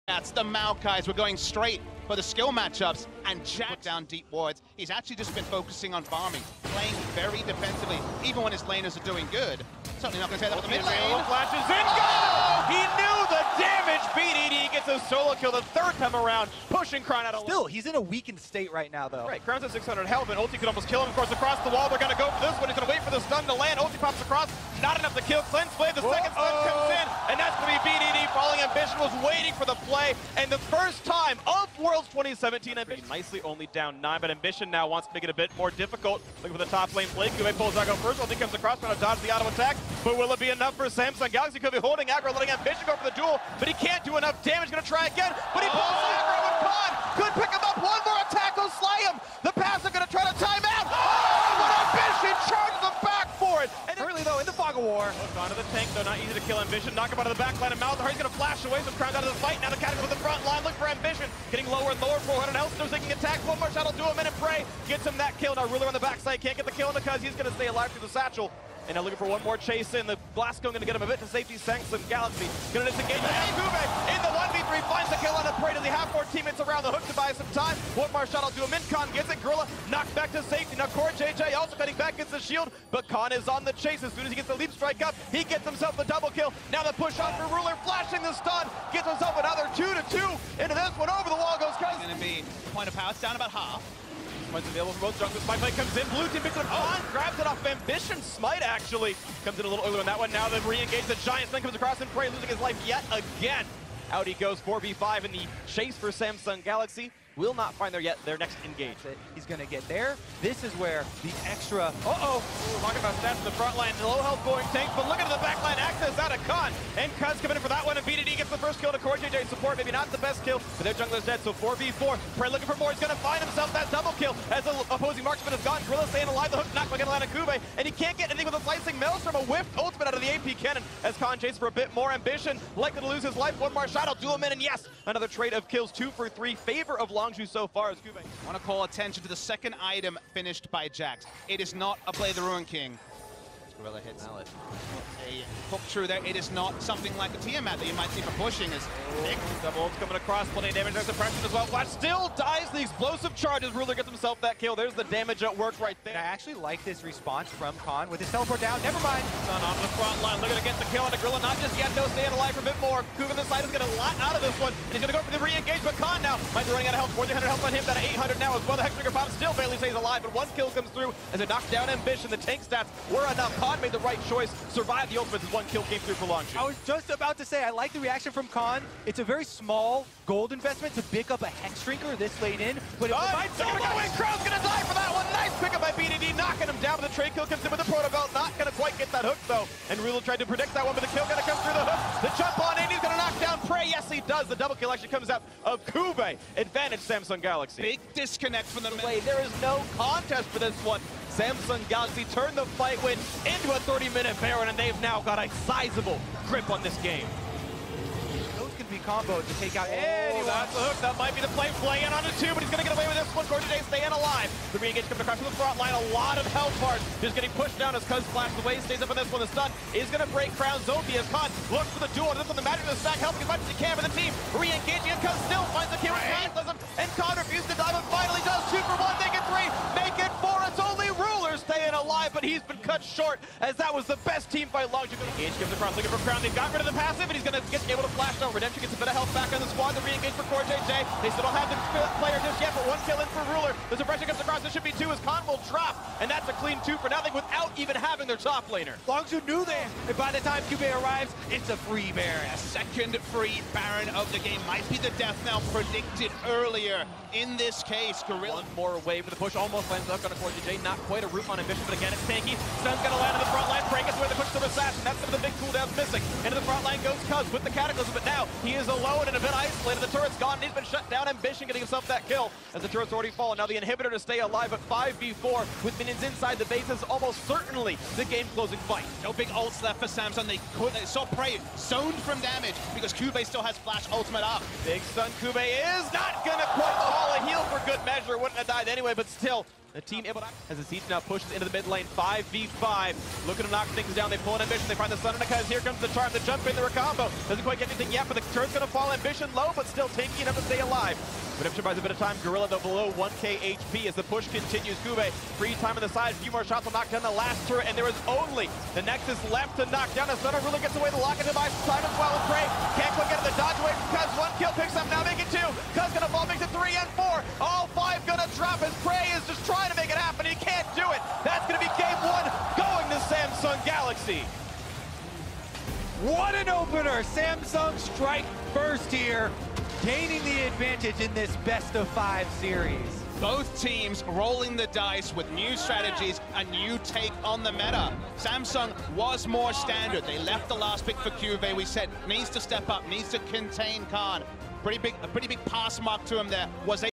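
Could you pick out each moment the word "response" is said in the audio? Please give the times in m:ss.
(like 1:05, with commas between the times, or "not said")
2:37.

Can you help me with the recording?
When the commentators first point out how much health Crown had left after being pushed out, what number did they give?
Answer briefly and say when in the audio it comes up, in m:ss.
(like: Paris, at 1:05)
600, at 0:19.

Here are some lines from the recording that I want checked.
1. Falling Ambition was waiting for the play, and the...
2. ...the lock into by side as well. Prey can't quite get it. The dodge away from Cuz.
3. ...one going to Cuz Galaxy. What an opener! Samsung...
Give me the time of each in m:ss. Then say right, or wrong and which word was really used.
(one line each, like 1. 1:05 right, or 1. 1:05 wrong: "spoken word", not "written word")
1. 0:28 right
2. 5:11 right
3. 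5:22 wrong: "Samsung", not "Cuz".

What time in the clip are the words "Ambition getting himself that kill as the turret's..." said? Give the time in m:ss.
4:31.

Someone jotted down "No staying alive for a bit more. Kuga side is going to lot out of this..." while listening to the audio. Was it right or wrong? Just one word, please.
right.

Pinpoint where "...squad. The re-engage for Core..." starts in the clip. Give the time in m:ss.
3:59.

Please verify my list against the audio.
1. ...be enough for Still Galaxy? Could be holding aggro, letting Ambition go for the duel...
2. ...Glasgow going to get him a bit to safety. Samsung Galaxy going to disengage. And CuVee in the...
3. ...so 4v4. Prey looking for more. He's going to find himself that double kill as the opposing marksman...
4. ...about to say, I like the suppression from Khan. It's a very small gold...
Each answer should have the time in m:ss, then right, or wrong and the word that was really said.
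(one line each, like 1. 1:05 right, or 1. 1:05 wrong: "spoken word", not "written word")
1. 0:40 wrong: "Samsung", not "Still"
2. 1:10 right
3. 2:01 right
4. 2:57 wrong: "reaction", not "suppression".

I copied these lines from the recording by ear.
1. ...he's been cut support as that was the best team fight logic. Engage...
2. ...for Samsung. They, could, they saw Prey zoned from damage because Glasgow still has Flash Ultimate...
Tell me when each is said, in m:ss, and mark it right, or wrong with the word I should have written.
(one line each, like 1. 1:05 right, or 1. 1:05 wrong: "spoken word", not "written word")
1. 3:52 wrong: "short", not "support"
2. 4:39 wrong: "CuVee", not "Glasgow".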